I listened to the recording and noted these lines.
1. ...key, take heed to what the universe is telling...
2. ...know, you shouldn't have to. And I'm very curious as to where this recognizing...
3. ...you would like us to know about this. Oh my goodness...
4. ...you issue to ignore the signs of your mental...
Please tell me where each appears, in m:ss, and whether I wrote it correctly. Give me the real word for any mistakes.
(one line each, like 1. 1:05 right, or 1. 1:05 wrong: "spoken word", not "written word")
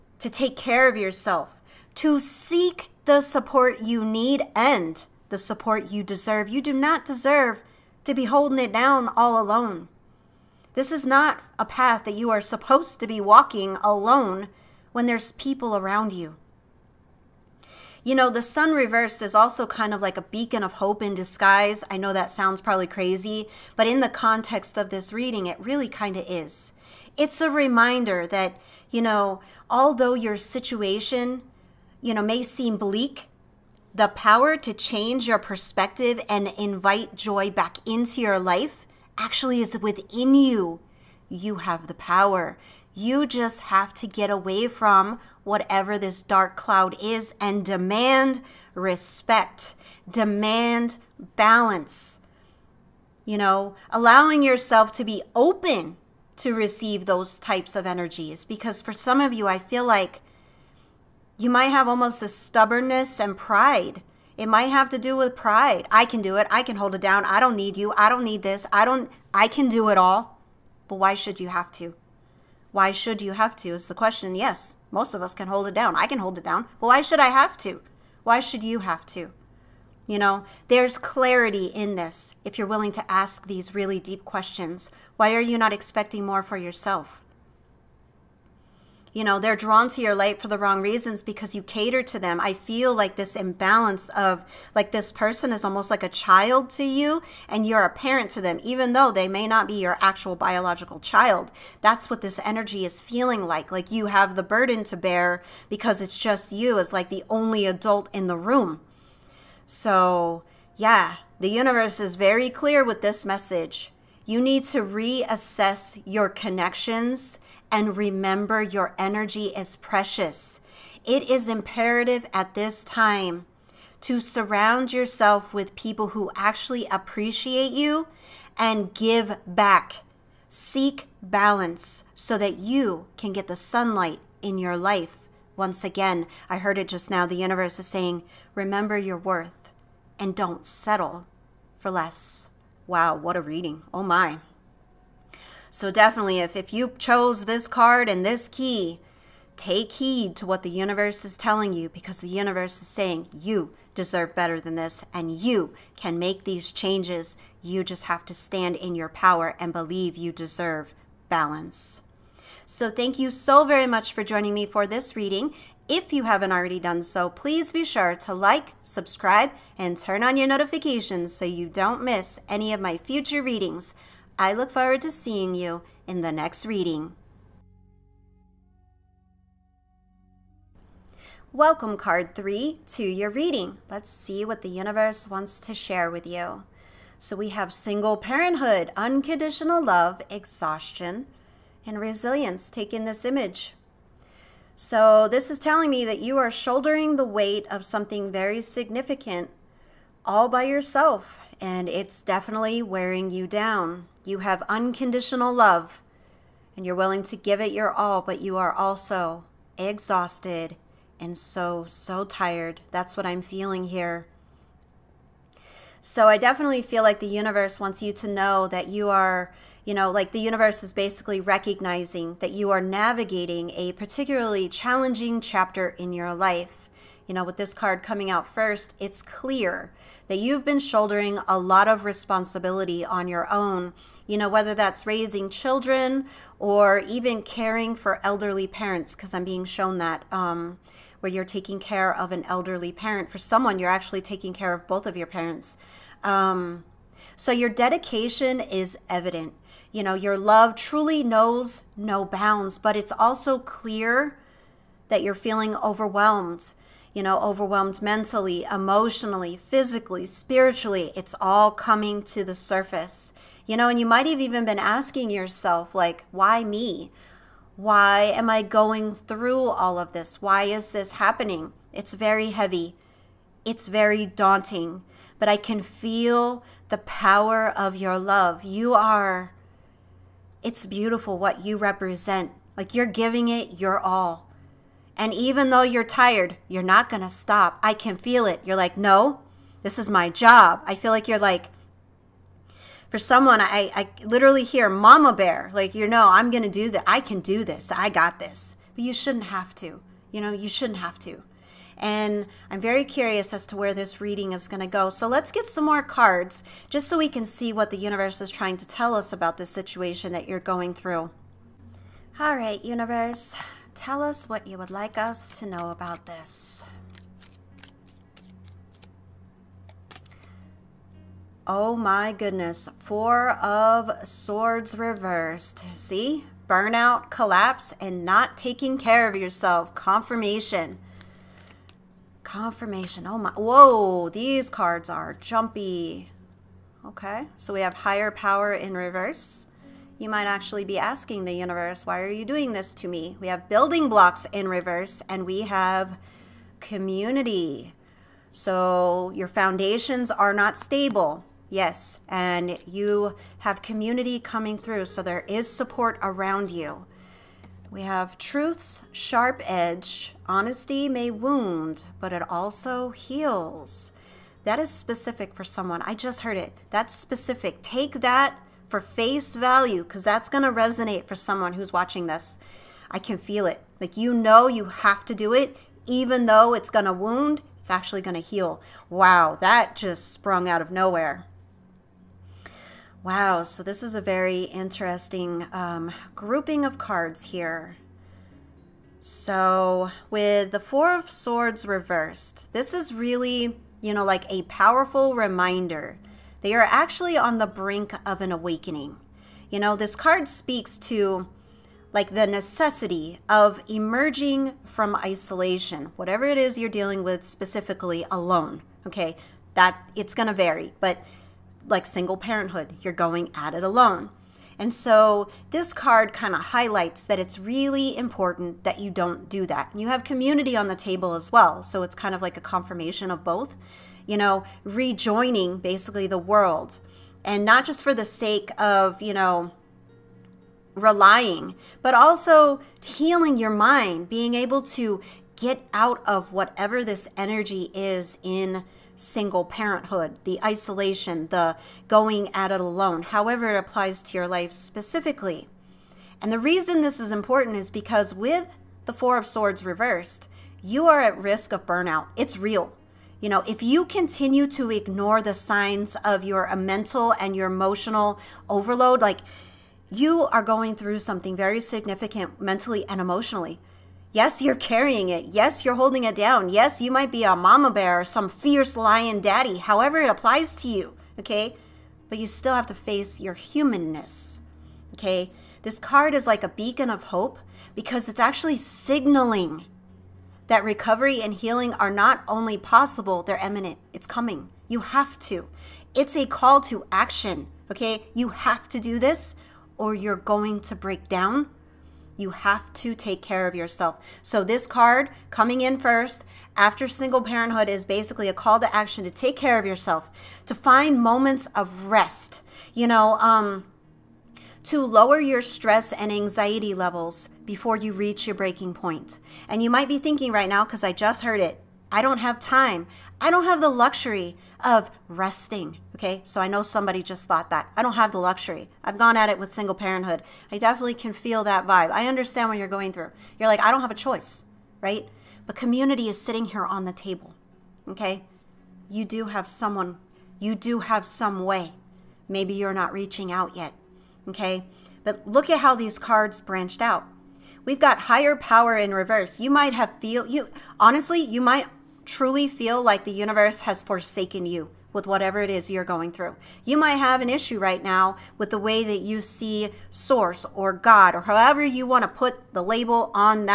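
1. 2:28 right
2. 5:00 wrong: "reading", not "recognizing"
3. 5:14 right
4. 7:33 wrong: "continue", not "issue".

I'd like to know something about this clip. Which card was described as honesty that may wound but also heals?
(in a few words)
Truth's sharp edge.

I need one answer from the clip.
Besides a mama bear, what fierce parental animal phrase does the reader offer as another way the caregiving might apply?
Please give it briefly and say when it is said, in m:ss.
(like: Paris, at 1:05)
Fierce lion daddy, at 7:48.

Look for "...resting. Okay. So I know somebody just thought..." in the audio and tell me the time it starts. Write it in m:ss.
8:35.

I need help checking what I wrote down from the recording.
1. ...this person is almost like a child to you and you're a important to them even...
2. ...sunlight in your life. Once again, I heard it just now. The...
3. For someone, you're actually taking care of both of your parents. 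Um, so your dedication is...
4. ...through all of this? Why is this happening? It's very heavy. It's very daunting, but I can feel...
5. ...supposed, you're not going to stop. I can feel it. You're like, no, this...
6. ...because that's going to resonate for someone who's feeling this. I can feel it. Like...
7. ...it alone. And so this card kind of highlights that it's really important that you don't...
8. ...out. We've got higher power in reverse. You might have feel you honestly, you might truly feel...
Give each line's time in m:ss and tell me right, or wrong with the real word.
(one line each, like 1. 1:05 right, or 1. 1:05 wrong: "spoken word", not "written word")
1. 1:34 wrong: "parent", not "important"
2. 2:13 right
3. 4:03 right
4. 4:29 right
5. 4:46 wrong: "tired", not "supposed"
6. 6:10 wrong: "watching", not "feeling"
7. 6:53 right
8. 8:57 right.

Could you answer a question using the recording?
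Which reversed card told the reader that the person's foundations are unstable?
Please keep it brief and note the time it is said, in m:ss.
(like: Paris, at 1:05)
Building blocks, at 5:43.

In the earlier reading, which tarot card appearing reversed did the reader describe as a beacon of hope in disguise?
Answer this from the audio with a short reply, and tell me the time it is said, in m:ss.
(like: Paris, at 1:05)
The Sun, at 0:18.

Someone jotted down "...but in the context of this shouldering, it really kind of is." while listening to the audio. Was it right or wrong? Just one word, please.
wrong.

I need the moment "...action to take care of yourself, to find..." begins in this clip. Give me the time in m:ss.
8:18.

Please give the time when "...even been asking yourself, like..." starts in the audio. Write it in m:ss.
4:24.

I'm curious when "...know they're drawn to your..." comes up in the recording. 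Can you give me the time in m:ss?
1:29.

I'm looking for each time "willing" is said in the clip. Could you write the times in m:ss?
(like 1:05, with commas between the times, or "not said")
1:22, 3:26.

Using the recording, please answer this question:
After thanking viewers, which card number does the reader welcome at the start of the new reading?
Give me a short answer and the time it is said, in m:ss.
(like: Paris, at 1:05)
3, at 3:01.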